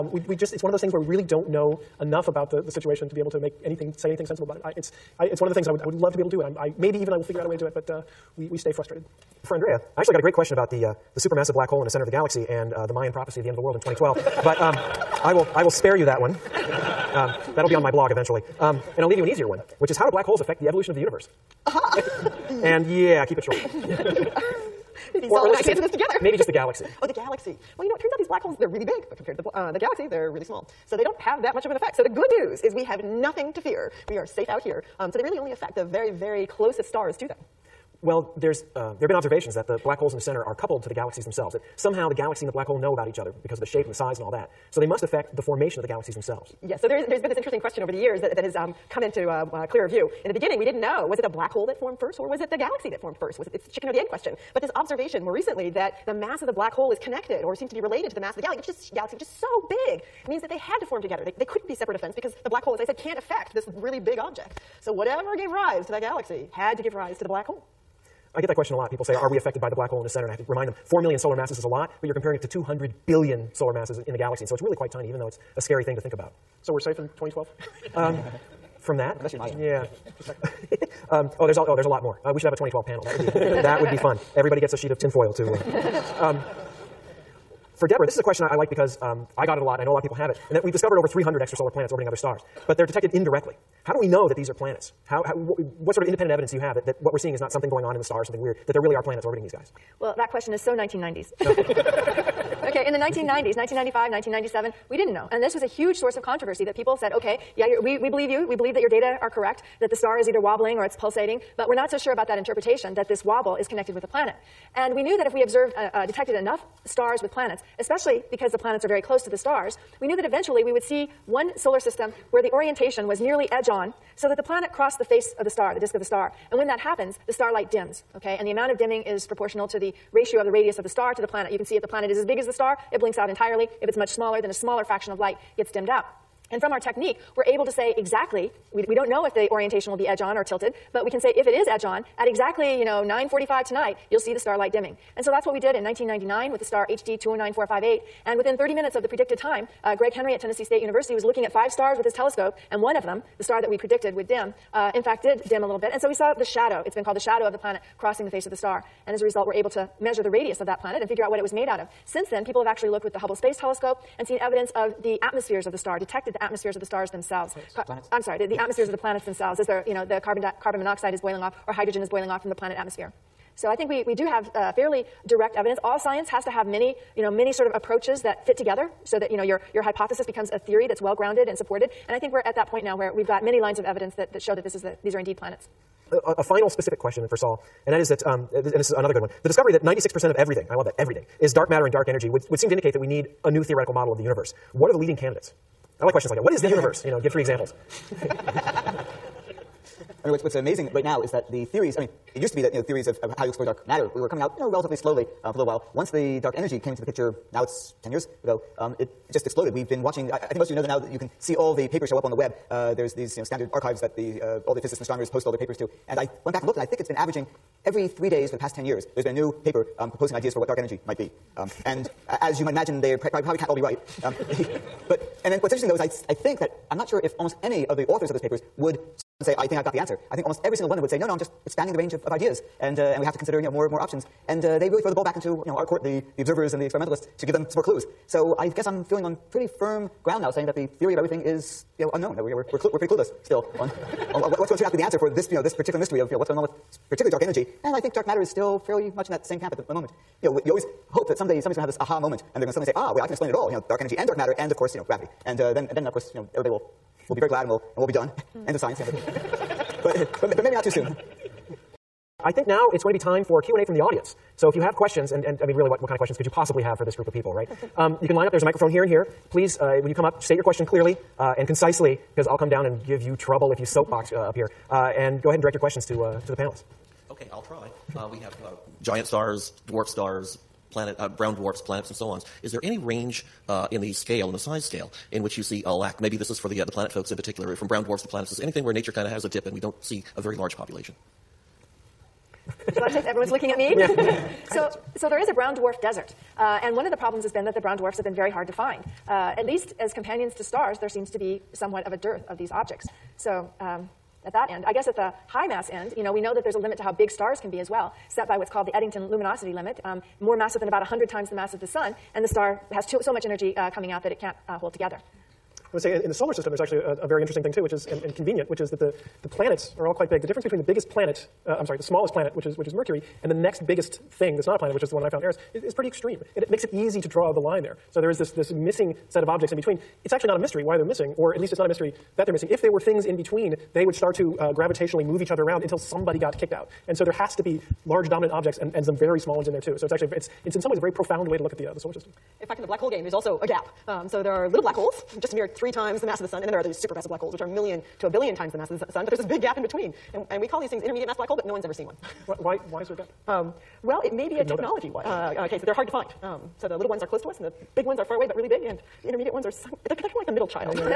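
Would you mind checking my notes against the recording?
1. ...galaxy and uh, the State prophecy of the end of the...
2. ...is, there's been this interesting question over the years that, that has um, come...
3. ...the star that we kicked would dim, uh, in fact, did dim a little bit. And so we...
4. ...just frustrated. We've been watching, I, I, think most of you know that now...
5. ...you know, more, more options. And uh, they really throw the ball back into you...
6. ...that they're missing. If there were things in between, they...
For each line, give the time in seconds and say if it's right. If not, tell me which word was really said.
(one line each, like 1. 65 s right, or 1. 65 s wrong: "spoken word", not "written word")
1. 12 s wrong: "Mayan", not "State"
2. 46 s right
3. 153 s wrong: "predicted", not "kicked"
4. 209 s wrong: "exploded", not "frustrated"
5. 233 s right
6. 332 s right.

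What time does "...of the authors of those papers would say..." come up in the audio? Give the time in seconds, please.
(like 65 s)
227 s.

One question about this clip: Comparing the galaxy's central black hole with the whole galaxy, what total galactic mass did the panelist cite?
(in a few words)
200 billion solar masses.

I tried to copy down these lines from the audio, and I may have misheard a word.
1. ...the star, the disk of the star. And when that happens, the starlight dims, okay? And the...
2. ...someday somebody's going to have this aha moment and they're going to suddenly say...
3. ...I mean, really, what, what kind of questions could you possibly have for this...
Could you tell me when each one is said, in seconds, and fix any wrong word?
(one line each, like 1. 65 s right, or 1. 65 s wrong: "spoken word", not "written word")
1. 125 s right
2. 251 s right
3. 265 s right.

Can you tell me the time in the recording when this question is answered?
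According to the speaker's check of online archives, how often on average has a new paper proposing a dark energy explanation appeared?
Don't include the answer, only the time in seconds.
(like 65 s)
217 s.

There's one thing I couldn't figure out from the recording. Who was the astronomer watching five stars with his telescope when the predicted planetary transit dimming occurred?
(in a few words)
Greg Henry.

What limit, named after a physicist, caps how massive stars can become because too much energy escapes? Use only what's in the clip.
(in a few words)
Eddington luminosity limit.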